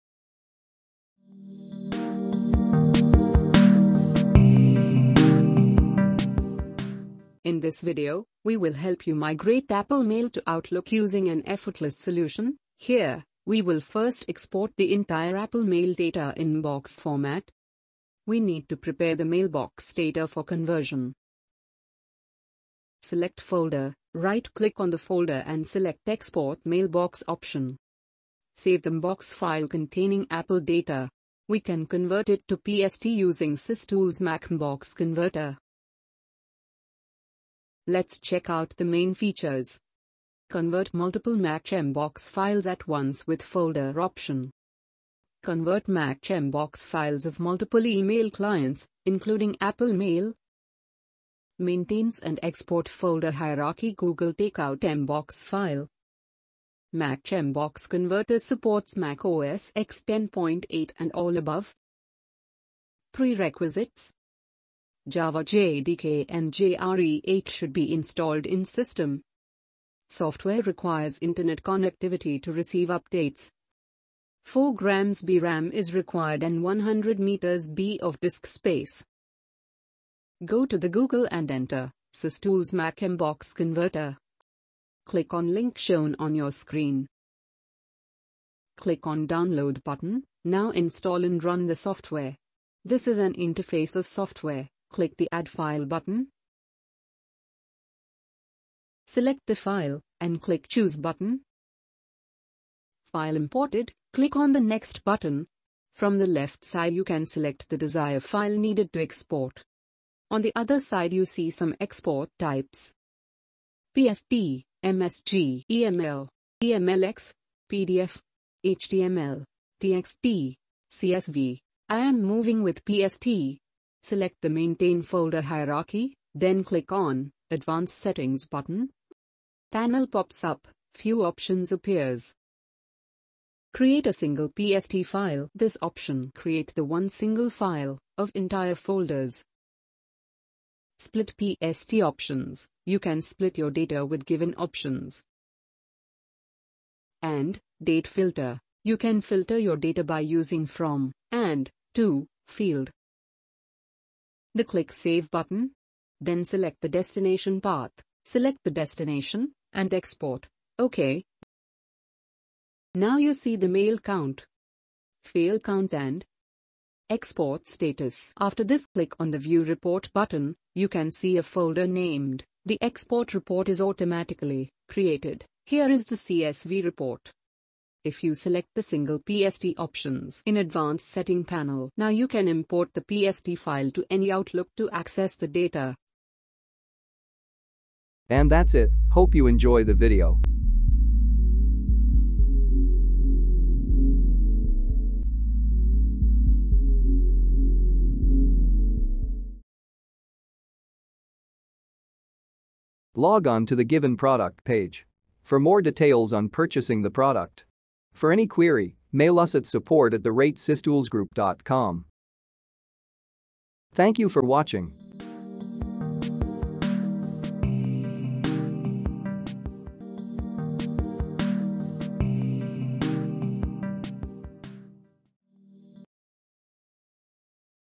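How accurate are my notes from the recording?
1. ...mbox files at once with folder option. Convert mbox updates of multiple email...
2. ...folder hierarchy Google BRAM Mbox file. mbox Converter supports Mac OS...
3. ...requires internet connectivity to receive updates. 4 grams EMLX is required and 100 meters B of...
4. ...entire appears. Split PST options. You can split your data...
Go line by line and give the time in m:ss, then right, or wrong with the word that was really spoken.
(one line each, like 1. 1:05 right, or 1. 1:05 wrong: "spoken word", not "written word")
1. 0:41 wrong: "files", not "updates"
2. 0:52 wrong: "Takeout", not "BRAM"
3. 1:10 wrong: "BRAM", not "EMLX"
4. 2:18 wrong: "folders", not "appears".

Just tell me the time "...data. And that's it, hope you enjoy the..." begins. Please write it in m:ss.
3:05.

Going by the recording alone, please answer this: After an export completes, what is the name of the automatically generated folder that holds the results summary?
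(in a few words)
Export Report.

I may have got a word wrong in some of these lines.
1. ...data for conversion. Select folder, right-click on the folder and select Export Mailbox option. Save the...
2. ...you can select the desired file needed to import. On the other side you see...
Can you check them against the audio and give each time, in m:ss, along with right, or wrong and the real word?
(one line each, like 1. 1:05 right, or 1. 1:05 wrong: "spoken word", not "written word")
1. 0:19 right
2. 1:46 wrong: "export", not "import".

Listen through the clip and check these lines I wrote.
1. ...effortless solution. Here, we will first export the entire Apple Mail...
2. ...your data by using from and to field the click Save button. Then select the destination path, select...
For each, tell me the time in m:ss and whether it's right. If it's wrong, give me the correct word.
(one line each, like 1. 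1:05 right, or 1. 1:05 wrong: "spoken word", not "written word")
1. 0:11 right
2. 2:29 right.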